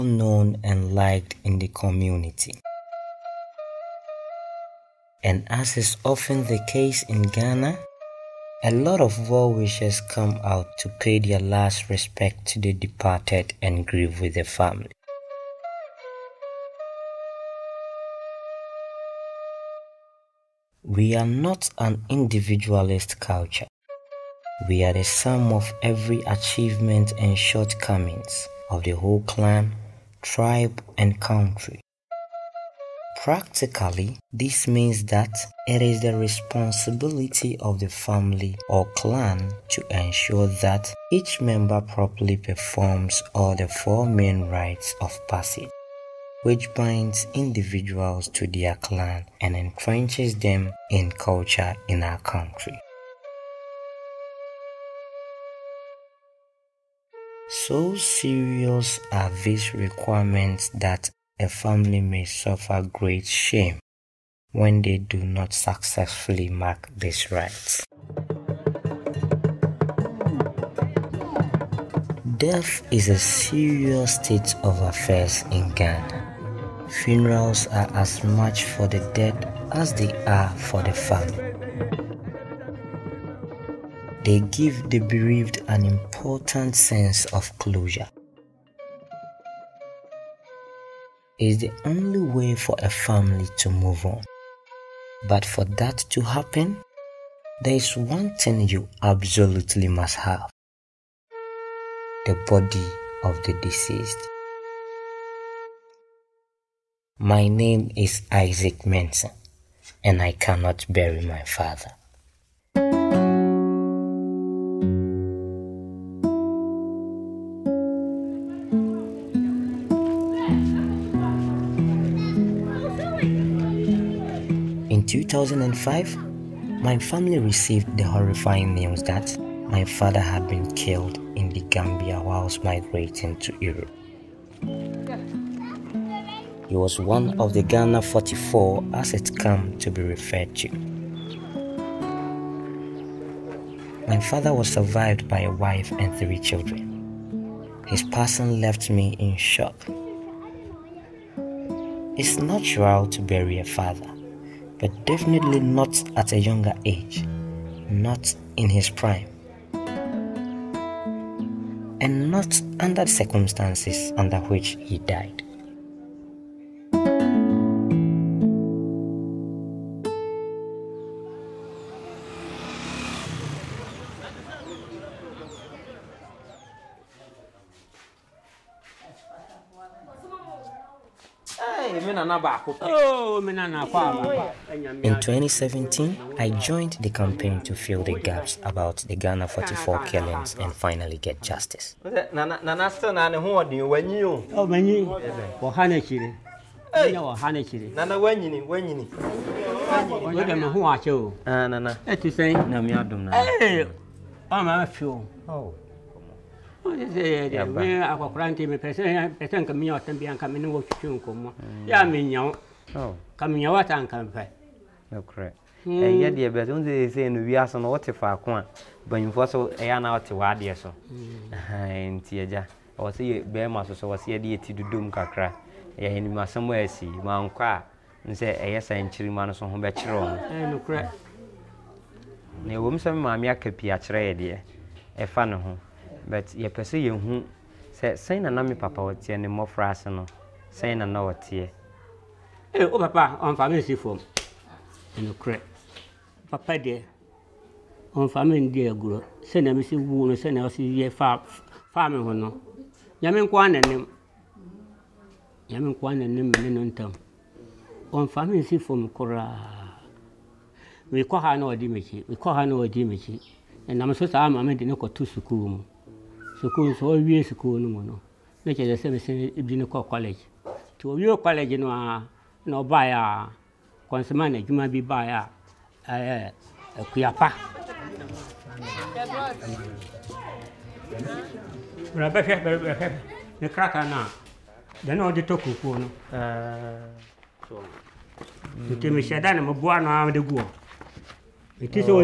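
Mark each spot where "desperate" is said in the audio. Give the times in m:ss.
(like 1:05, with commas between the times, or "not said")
not said.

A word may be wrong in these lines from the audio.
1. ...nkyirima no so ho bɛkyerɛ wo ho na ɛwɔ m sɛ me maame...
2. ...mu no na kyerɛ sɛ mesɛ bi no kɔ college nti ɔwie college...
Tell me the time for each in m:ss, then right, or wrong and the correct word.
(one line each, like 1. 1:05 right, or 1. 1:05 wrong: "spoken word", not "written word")
1. 3:48 right
2. 4:27 right.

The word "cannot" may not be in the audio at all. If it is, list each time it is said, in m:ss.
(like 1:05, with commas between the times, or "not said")
1:50.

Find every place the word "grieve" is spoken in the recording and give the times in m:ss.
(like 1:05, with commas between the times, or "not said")
0:13.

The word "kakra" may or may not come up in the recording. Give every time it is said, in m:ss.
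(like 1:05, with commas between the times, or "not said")
3:45.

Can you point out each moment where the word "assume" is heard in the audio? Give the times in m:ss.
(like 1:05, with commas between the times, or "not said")
not said.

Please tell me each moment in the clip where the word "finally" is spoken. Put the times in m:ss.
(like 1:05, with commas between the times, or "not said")
3:10.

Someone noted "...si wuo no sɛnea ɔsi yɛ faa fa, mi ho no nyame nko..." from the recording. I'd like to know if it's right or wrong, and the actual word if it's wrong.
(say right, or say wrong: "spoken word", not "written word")
right.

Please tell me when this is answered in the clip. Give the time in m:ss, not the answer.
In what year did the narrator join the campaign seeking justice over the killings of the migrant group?
3:05.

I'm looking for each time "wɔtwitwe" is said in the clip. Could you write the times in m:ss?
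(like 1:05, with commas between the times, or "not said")
3:30.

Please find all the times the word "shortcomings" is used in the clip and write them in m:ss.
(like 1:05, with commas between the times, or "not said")
0:27.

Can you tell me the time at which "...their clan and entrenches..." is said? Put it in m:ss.
0:48.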